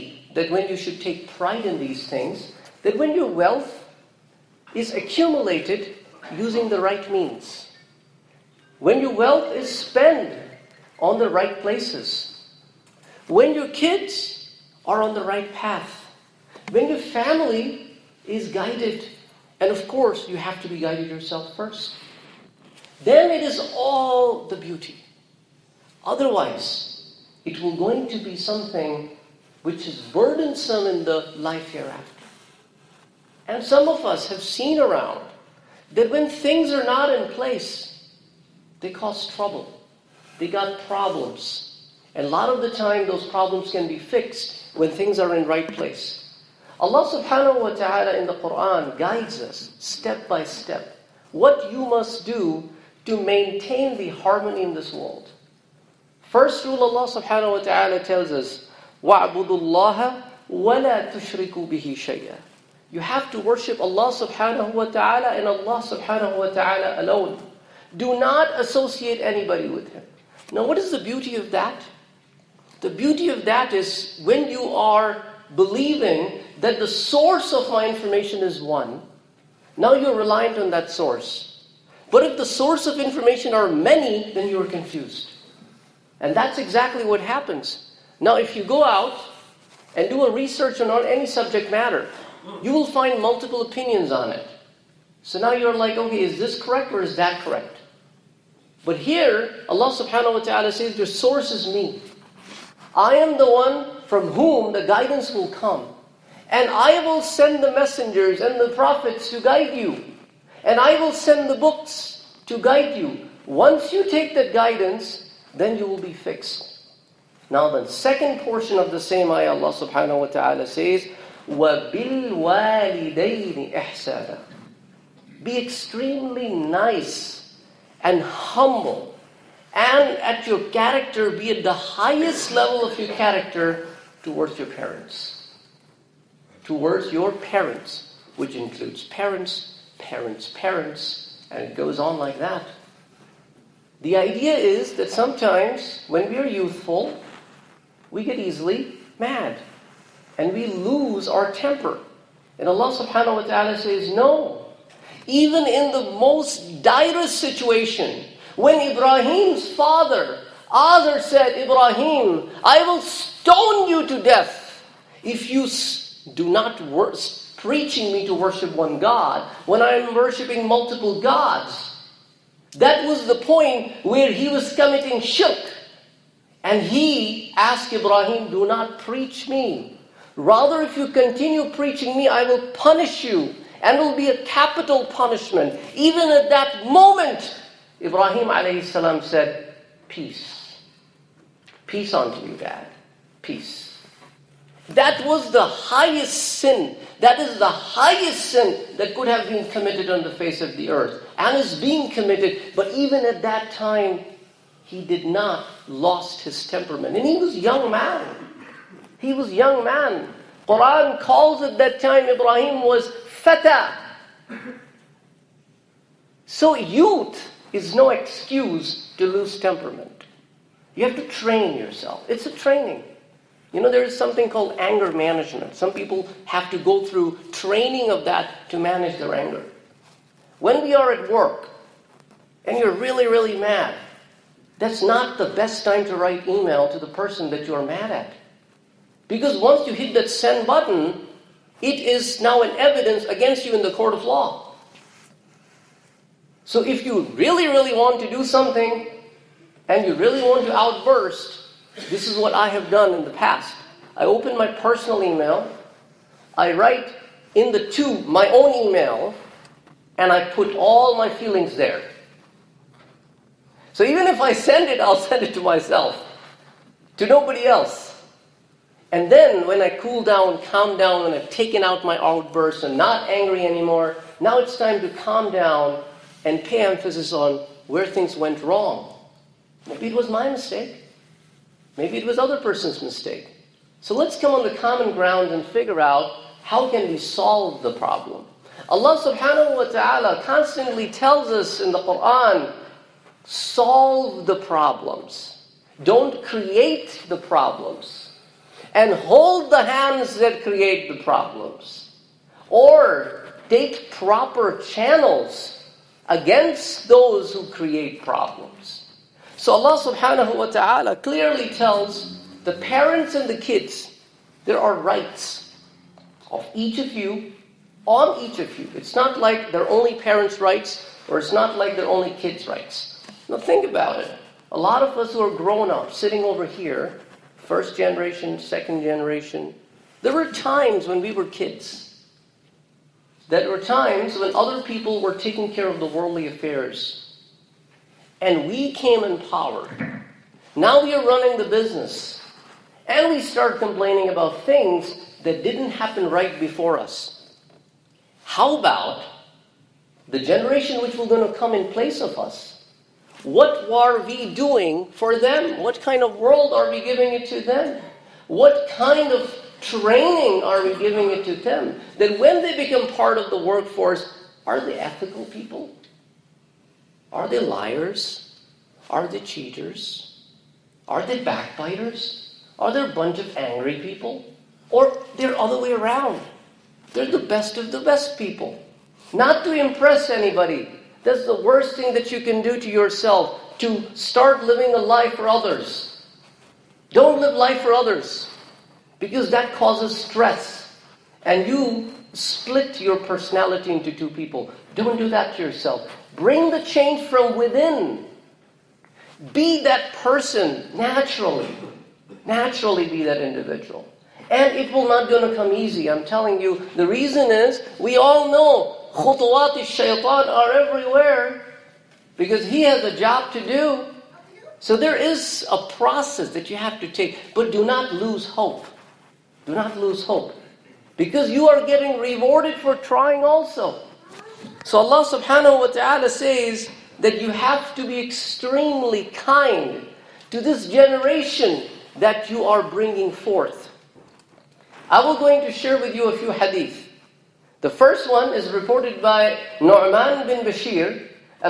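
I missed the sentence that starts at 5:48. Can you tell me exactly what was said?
How about the generation which will going to come in place of us?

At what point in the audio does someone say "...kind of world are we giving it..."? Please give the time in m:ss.
5:56.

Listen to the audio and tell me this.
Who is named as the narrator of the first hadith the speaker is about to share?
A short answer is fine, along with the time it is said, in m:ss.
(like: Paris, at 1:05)
Nu'man bin Bashir, at 7:19.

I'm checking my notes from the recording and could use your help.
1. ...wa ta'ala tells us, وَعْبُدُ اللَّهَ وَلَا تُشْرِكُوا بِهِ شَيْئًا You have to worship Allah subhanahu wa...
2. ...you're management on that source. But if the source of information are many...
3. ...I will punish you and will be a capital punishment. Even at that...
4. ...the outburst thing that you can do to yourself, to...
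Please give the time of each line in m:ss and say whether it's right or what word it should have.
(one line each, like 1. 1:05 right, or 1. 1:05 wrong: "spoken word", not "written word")
1. 0:57 right
2. 1:19 wrong: "reliant", not "management"
3. 3:02 right
4. 6:21 wrong: "worst", not "outburst".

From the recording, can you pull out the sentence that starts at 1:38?
But here, Allah subhanahu wa ta'ala says, Your source is me.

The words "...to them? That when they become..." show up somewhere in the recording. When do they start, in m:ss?
6:01.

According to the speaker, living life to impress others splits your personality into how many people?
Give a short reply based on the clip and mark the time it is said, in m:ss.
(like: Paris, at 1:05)
2, at 6:34.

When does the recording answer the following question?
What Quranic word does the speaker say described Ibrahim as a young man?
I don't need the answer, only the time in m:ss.
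3:33.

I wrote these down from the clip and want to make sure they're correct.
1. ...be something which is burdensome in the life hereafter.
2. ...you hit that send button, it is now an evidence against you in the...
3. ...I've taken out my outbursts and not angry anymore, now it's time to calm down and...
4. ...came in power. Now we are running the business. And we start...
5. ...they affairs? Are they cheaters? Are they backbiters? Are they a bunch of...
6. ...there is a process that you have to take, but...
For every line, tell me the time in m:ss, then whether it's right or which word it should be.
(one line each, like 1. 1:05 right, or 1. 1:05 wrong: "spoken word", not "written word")
1. 0:28 right
2. 3:59 right
3. 4:31 right
4. 5:38 right
5. 6:07 wrong: "liars", not "affairs"
6. 6:54 right.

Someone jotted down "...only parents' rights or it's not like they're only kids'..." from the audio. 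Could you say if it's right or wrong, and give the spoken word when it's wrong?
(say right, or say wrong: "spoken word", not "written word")
right.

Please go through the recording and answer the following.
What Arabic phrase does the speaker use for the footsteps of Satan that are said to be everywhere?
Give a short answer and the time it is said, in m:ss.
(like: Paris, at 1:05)
Khutuwat shaitan, at 6:49.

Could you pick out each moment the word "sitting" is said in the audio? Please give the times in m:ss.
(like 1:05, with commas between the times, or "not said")
5:26.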